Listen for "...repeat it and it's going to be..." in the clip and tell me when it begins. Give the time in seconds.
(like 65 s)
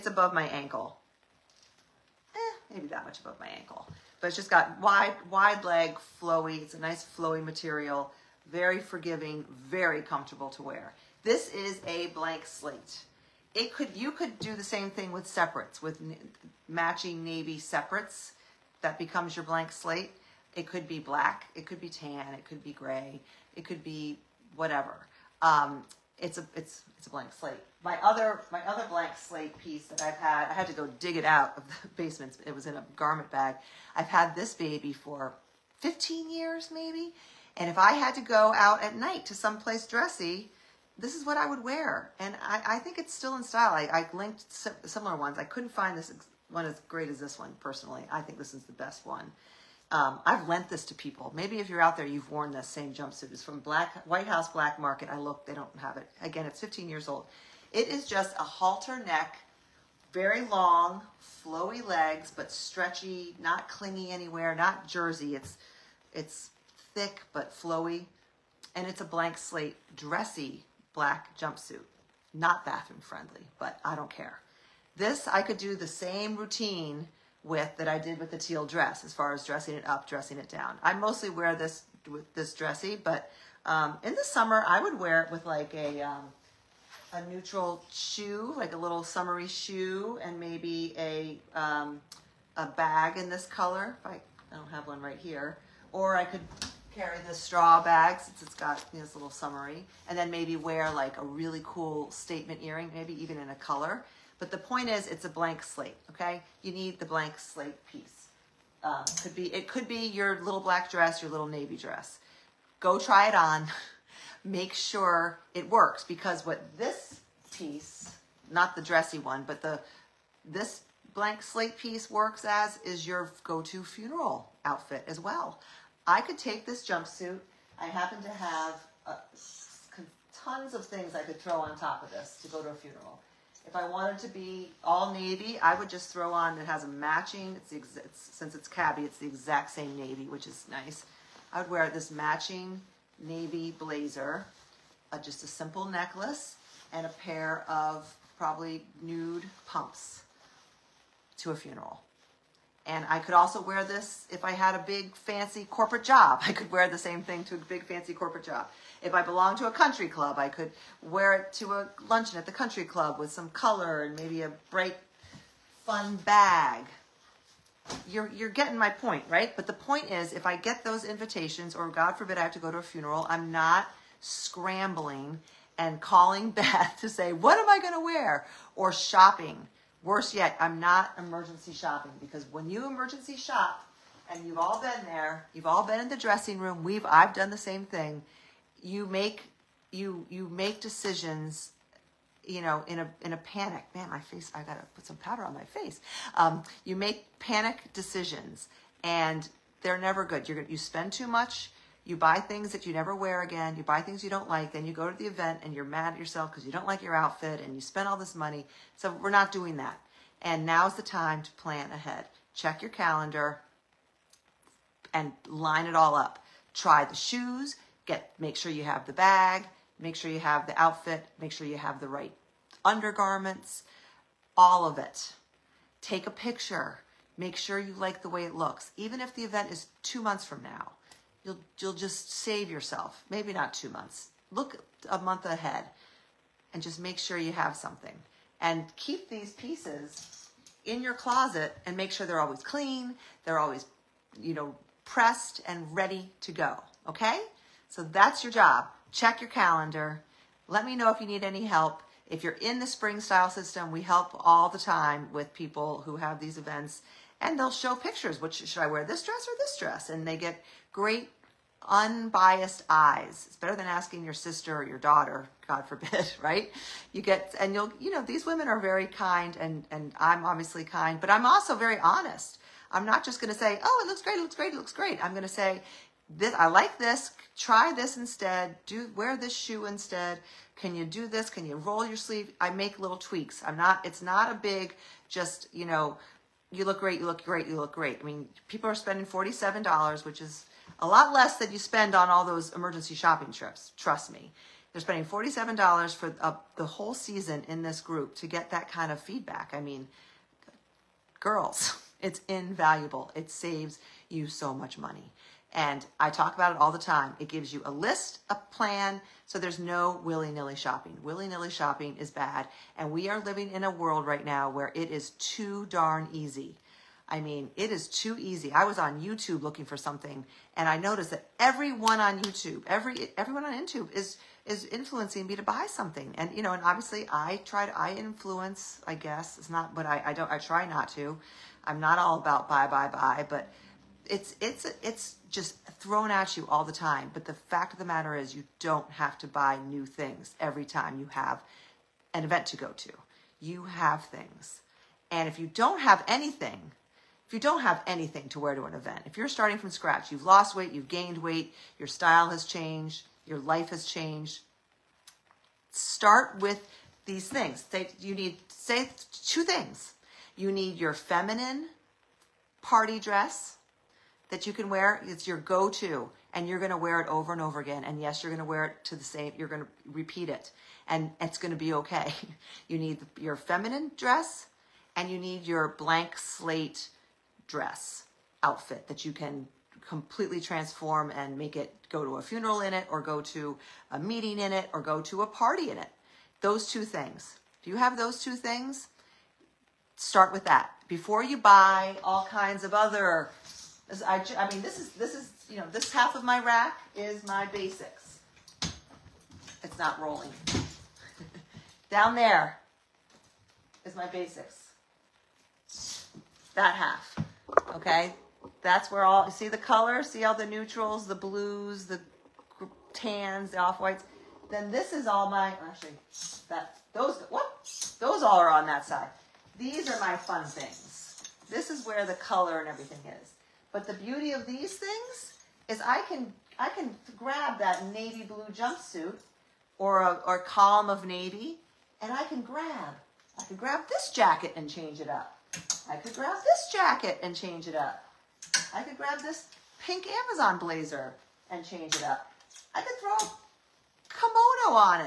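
370 s.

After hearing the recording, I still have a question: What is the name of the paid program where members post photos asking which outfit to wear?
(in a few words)
spring style system.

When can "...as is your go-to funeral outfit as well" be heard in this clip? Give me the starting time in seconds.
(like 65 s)
122 s.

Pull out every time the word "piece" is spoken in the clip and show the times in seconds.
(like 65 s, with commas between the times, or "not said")
29 s, 107 s, 117 s, 121 s, 239 s.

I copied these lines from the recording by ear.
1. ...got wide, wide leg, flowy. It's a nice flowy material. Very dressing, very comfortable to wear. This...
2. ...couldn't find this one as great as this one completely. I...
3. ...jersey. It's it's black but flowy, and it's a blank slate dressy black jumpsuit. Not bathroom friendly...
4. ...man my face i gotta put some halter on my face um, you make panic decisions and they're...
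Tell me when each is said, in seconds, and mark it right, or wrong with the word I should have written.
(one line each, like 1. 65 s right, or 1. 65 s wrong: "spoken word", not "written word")
1. 4 s wrong: "forgiving", not "dressing"
2. 45 s wrong: "personally", not "completely"
3. 64 s wrong: "thick", not "black"
4. 193 s wrong: "powder", not "halter".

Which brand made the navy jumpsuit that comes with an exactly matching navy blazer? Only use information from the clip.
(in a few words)
cabi.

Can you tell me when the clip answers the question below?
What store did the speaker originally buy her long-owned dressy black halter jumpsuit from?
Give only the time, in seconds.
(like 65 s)
54 s.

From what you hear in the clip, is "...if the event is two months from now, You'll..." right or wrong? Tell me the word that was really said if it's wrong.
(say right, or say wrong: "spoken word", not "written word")
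right.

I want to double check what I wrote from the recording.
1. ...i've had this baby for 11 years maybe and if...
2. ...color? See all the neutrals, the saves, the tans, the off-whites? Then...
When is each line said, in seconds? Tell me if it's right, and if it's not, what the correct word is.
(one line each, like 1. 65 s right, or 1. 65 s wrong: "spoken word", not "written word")
1. 33 s wrong: "15", not "11"
2. 409 s wrong: "blues", not "saves".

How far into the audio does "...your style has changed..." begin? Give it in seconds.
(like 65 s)
351 s.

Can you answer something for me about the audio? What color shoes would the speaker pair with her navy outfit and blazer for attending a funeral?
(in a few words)
nude pumps.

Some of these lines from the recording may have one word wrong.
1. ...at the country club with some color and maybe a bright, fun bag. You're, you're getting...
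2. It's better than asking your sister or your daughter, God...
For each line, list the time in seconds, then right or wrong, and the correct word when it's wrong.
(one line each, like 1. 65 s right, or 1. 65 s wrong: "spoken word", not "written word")
1. 162 s right
2. 263 s right.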